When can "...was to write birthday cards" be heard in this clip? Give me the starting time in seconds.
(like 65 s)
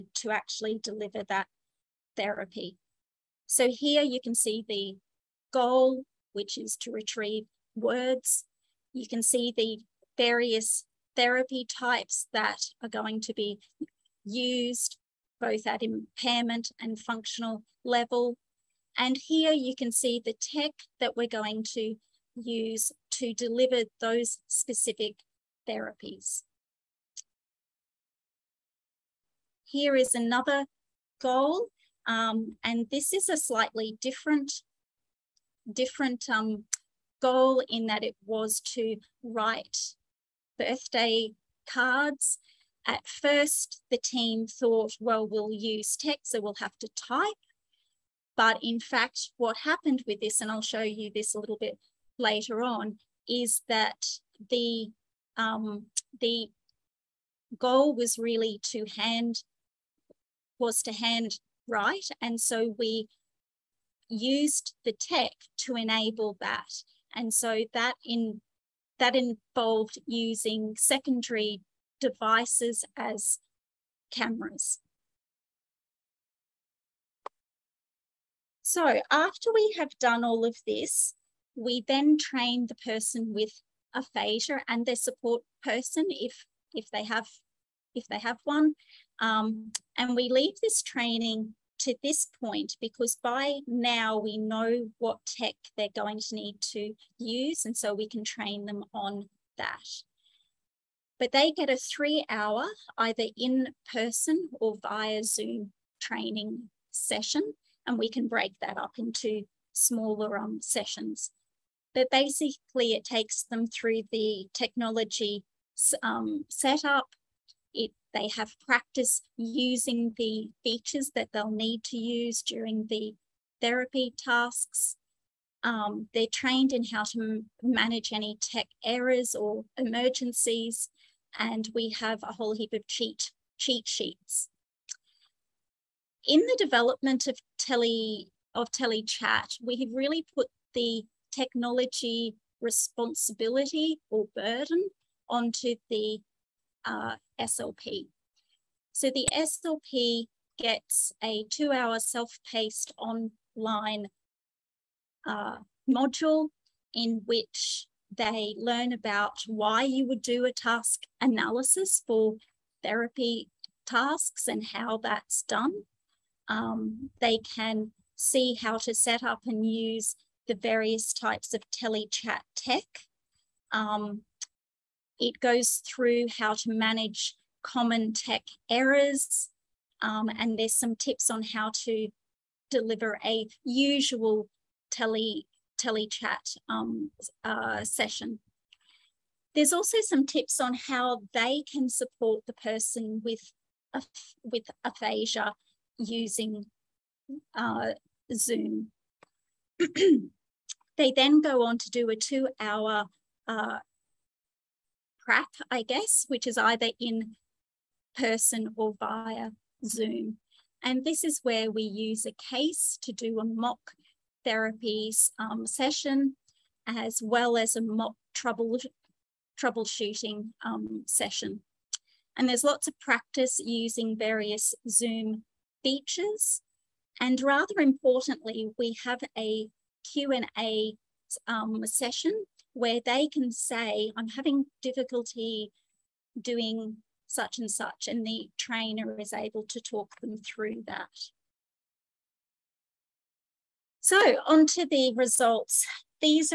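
38 s.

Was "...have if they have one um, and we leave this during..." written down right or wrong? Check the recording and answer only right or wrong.
wrong.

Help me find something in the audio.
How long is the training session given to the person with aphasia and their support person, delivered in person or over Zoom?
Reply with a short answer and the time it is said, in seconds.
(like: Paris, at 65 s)
3 hours, at 101 s.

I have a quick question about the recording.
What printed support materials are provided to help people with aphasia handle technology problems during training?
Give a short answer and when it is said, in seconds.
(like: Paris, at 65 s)
cheat sheets, at 133 s.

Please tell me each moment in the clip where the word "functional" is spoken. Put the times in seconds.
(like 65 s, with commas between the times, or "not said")
16 s.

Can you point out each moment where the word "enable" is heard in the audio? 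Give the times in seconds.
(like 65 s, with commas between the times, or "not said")
65 s.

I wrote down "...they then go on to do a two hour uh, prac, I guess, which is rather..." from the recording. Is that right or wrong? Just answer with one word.
wrong.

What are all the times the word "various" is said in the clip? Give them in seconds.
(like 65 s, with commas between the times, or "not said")
10 s, 170 s, 224 s.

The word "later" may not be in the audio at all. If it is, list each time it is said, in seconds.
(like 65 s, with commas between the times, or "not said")
52 s.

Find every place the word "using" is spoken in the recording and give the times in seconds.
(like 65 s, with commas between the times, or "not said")
70 s, 119 s, 195 s, 223 s.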